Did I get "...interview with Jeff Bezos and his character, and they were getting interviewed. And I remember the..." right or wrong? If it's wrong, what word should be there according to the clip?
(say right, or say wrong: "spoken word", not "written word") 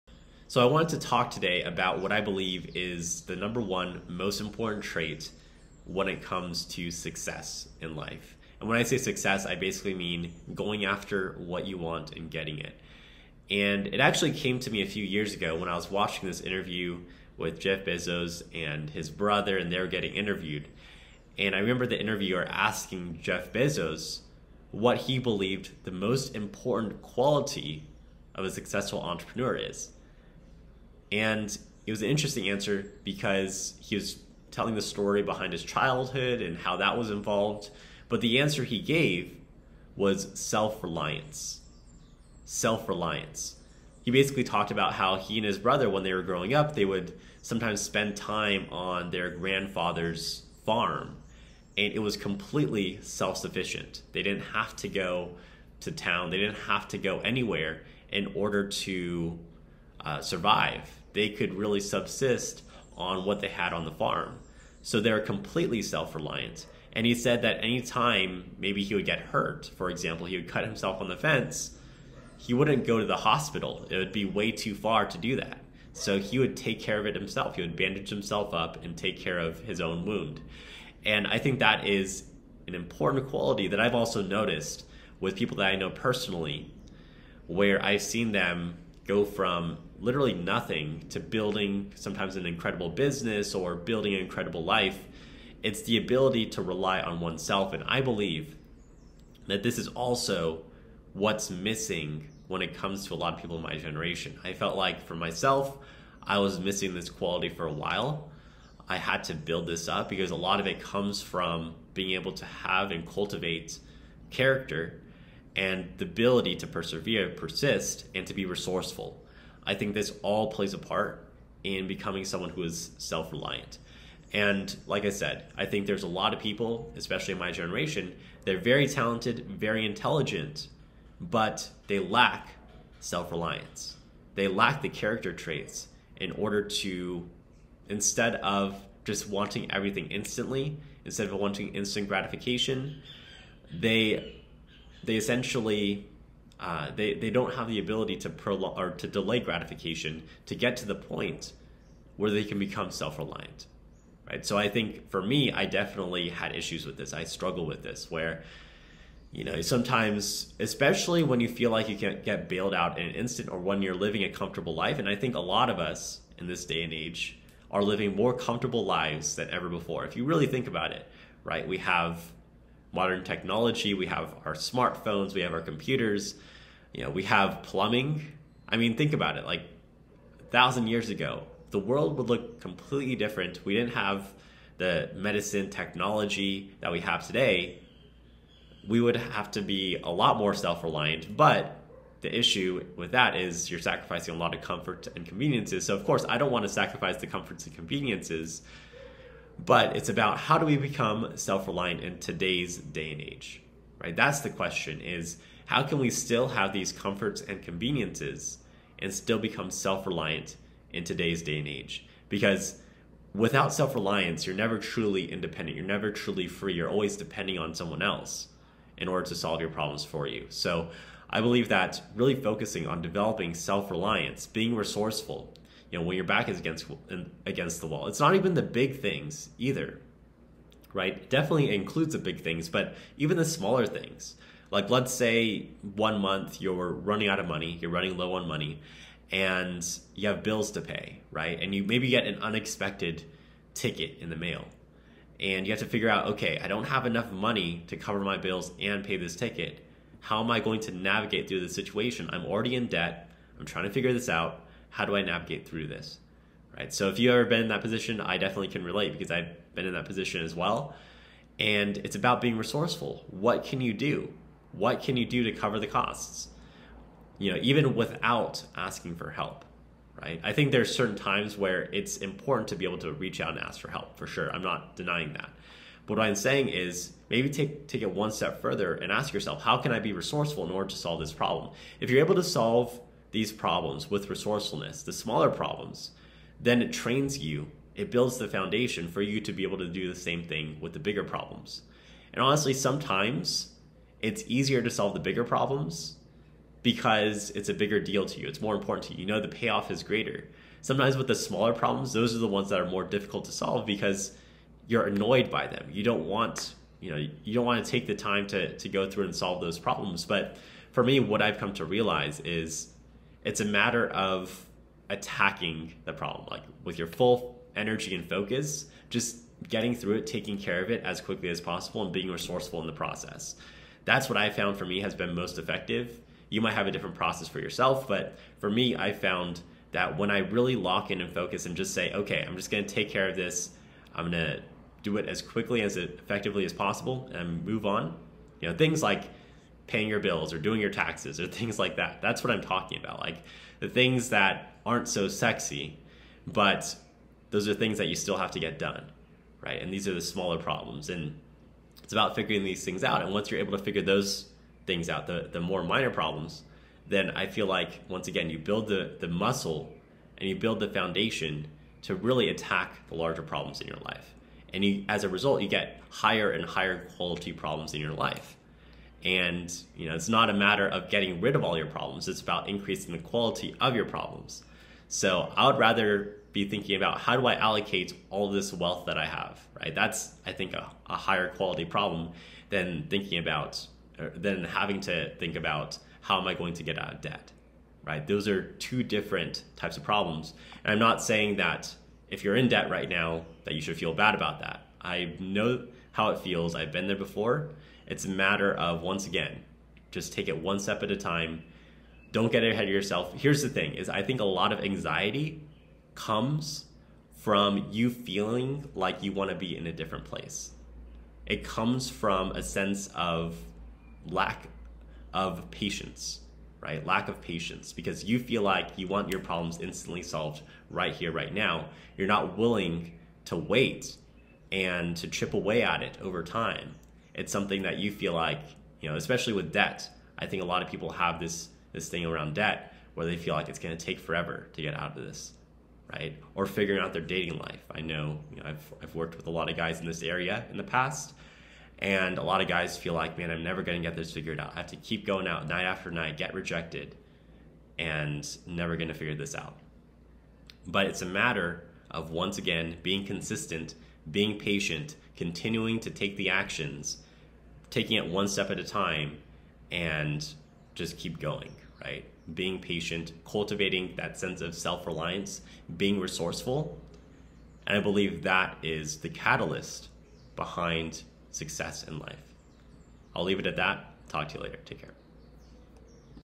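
wrong: "brother", not "character".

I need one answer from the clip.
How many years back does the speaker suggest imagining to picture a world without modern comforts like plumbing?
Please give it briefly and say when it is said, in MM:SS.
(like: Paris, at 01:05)
1,000 years, at 03:00.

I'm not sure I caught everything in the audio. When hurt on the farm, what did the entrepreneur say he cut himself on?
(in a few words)
The fence.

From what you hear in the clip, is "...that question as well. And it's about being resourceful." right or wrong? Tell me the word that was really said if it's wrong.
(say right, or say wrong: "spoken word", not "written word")
wrong: "position", not "question".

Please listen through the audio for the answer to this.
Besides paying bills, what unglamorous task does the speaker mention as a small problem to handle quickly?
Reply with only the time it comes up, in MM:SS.
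05:40.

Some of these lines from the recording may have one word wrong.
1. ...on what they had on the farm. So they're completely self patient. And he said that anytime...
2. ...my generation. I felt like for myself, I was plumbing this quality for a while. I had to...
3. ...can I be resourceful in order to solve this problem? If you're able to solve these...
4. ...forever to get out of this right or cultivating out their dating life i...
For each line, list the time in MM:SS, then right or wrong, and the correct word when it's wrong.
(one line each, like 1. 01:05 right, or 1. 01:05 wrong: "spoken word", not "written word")
1. 01:02 wrong: "reliant", not "patient"
2. 01:43 wrong: "missing", not "plumbing"
3. 04:39 right
4. 07:14 wrong: "figuring", not "cultivating".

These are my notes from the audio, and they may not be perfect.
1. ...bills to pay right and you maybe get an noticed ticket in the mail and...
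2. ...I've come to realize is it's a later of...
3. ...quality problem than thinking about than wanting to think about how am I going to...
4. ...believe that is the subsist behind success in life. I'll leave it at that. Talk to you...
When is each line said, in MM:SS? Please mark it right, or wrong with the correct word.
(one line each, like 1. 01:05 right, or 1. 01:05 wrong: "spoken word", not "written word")
1. 04:00 wrong: "unexpected", not "noticed"
2. 05:11 wrong: "matter", not "later"
3. 06:21 wrong: "having", not "wanting"
4. 07:48 wrong: "catalyst", not "subsist".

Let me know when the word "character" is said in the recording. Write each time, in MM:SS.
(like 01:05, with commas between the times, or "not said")
01:54, 02:14.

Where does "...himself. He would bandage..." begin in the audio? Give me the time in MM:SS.
01:17.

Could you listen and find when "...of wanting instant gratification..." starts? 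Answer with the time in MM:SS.
02:21.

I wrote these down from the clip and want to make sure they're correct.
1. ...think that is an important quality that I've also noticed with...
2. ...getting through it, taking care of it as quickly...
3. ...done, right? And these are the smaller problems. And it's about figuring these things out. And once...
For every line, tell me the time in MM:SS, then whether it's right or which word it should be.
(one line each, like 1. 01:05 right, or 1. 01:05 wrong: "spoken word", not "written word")
1. 01:21 right
2. 05:19 right
3. 05:48 right.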